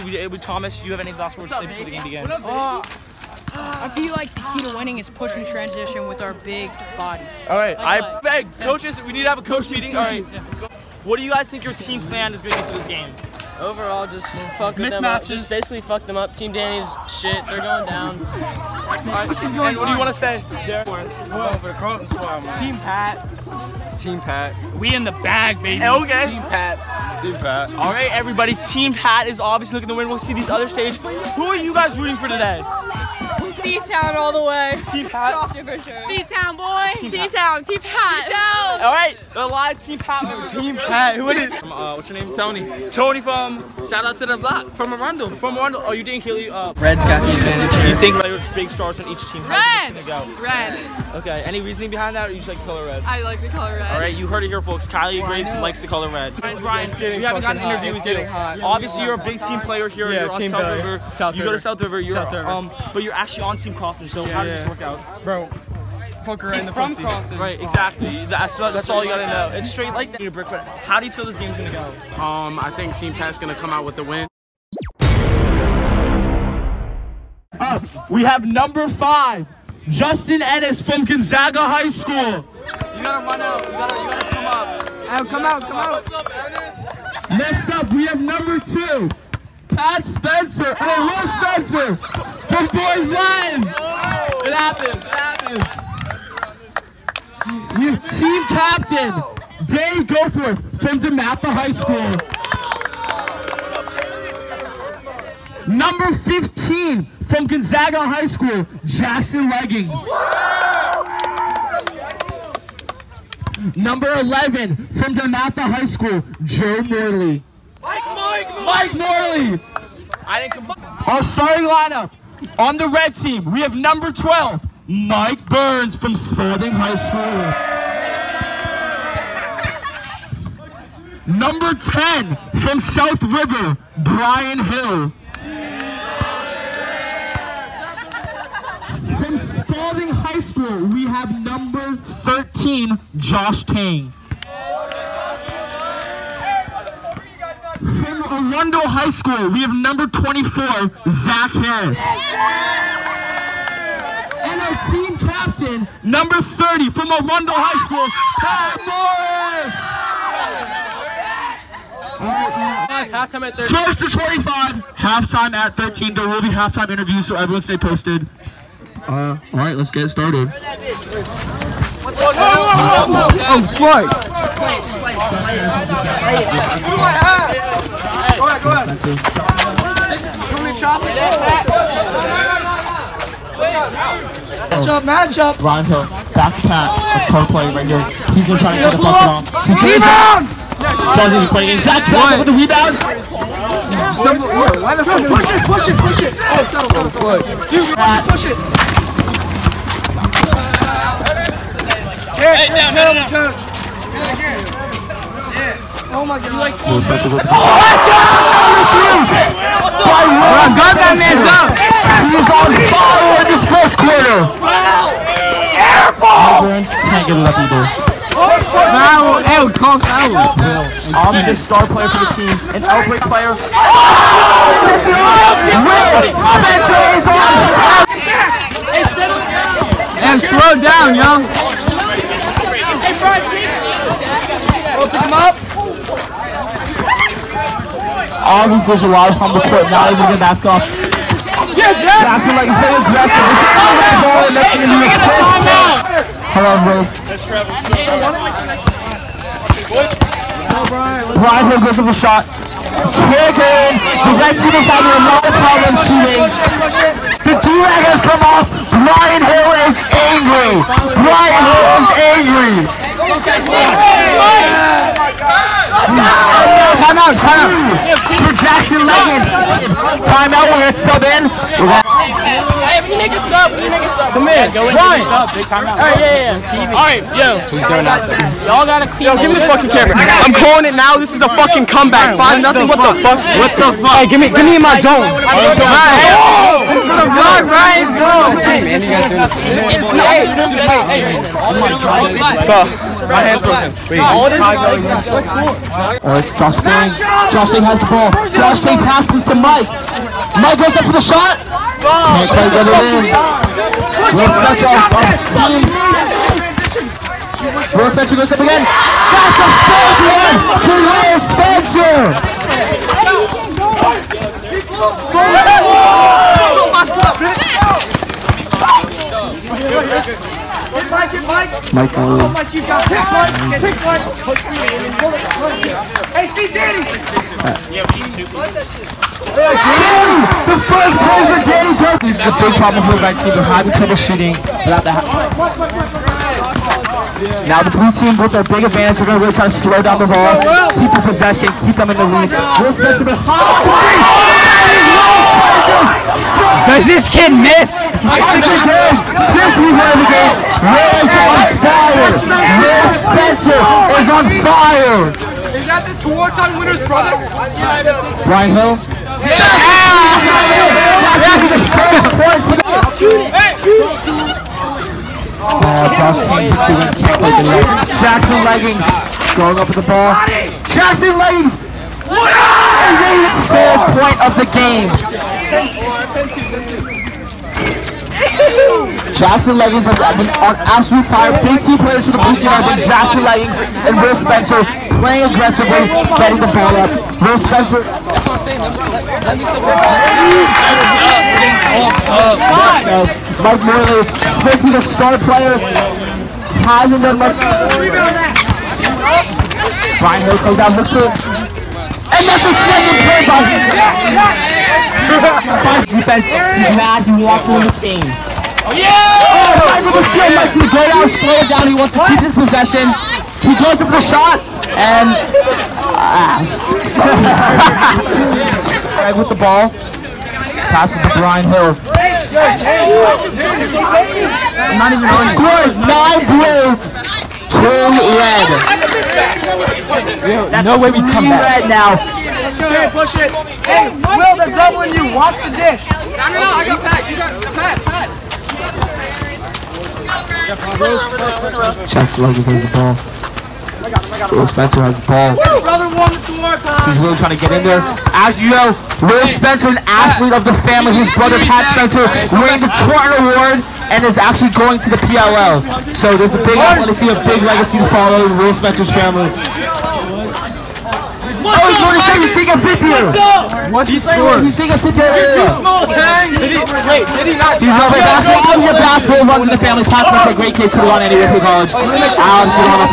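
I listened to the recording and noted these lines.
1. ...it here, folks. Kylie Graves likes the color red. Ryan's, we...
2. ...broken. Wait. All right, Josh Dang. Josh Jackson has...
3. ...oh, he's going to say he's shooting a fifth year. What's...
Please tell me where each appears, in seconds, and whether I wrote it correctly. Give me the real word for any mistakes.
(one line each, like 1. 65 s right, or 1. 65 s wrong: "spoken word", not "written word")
1. 54 s right
2. 293 s wrong: "Dang", not "Jackson"
3. 461 s wrong: "taking", not "shooting".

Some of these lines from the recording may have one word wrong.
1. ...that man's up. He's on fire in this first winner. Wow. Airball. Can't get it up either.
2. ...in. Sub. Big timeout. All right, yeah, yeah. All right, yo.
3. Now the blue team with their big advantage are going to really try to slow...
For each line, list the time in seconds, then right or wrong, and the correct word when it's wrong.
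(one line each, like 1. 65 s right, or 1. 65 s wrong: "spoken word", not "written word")
1. 210 s wrong: "quarter", not "winner"
2. 274 s right
3. 337 s right.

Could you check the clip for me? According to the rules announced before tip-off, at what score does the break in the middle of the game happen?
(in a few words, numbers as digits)
13.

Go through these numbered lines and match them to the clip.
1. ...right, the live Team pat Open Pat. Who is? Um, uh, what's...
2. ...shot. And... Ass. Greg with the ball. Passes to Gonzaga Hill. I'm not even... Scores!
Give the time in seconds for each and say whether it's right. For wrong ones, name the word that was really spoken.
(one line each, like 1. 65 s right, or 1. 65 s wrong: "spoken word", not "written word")
1. 38 s wrong: "Team", not "Open"
2. 414 s wrong: "Brian", not "Gonzaga".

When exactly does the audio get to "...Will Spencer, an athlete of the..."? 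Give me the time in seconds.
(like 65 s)
449 s.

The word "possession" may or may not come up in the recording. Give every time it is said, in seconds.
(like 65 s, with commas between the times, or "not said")
341 s, 412 s.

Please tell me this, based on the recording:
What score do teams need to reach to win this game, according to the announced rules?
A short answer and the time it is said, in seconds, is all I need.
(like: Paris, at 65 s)
25, at 163 s.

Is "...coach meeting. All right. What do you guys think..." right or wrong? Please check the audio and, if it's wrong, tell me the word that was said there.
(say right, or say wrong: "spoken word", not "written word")
right.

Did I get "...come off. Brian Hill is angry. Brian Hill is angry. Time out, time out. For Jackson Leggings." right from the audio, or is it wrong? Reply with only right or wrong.
right.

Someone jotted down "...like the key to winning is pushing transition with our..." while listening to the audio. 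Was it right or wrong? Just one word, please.
right.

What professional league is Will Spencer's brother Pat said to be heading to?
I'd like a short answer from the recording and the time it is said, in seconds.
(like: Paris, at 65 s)
PLL, at 455 s.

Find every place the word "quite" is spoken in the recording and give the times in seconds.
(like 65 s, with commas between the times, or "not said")
302 s.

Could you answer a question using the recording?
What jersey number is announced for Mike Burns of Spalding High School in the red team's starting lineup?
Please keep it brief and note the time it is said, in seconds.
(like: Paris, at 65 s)
12, at 123 s.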